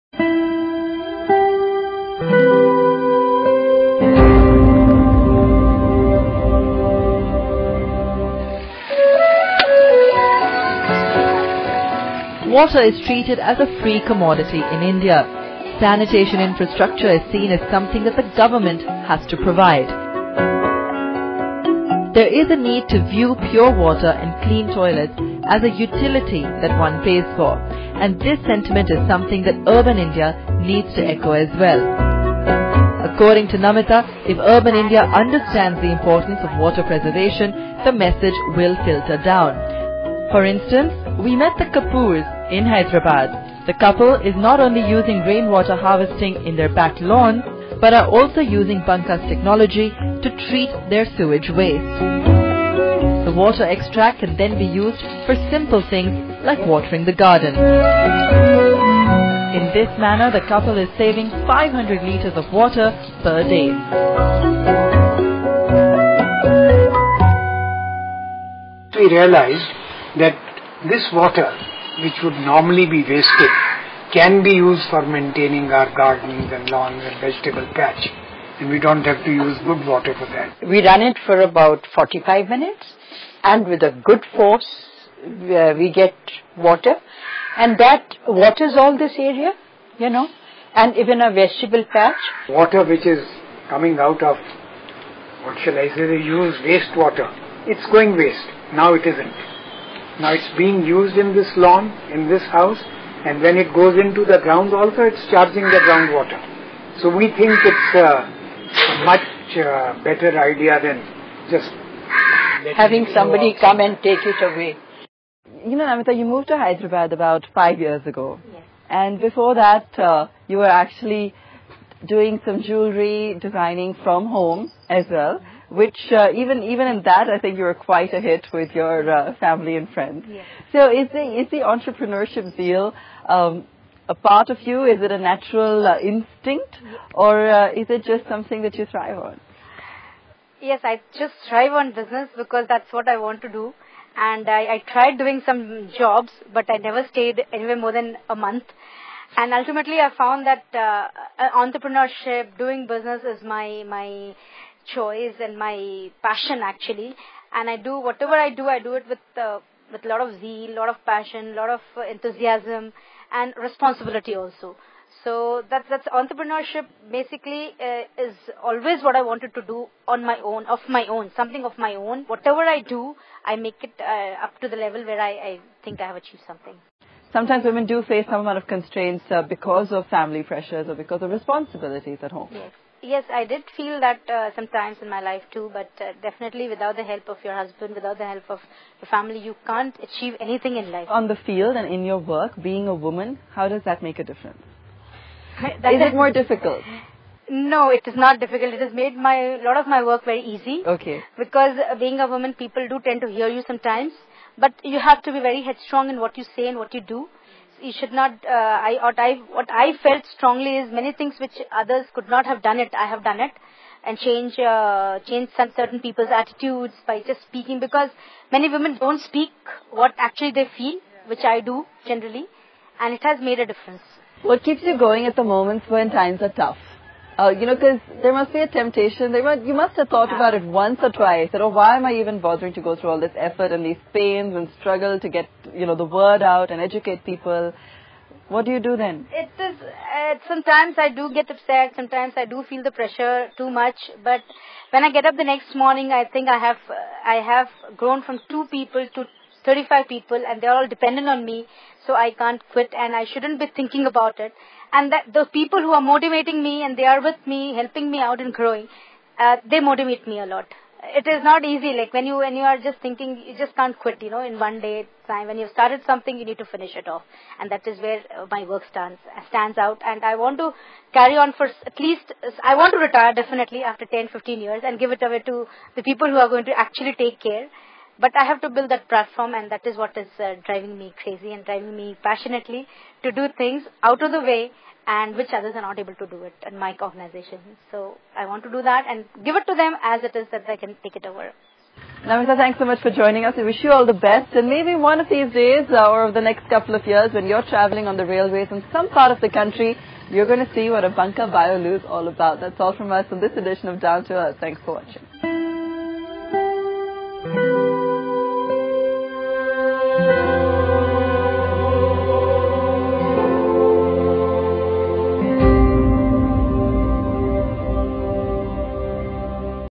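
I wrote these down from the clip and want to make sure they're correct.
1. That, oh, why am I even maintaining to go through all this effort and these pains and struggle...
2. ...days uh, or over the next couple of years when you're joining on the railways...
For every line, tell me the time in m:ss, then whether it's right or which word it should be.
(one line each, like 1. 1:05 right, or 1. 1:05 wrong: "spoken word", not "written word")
1. 3:51 wrong: "bothering", not "maintaining"
2. 4:55 wrong: "traveling", not "joining".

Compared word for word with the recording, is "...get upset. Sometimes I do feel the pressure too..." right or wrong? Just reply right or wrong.
right.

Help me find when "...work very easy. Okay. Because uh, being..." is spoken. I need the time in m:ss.
3:20.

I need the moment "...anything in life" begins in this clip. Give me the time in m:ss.
3:10.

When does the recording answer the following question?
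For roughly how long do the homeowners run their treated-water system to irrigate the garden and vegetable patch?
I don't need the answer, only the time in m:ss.
1:21.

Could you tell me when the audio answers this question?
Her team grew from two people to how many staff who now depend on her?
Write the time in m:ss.
4:09.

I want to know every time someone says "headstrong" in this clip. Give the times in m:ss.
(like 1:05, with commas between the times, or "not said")
3:25.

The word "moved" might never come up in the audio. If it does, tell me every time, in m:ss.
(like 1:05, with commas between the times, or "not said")
1:56.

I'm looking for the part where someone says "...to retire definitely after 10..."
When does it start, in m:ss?
4:32.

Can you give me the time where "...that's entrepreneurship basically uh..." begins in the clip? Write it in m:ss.
2:45.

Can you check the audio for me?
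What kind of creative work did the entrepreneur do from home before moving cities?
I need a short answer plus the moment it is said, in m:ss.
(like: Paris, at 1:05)
jewelry designing, at 2:02.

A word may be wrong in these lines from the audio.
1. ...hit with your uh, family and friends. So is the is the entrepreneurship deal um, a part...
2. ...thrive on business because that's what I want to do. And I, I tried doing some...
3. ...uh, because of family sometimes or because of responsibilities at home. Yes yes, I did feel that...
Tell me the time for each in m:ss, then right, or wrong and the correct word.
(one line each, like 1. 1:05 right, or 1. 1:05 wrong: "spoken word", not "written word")
1. 2:08 right
2. 2:21 right
3. 2:59 wrong: "pressures", not "sometimes".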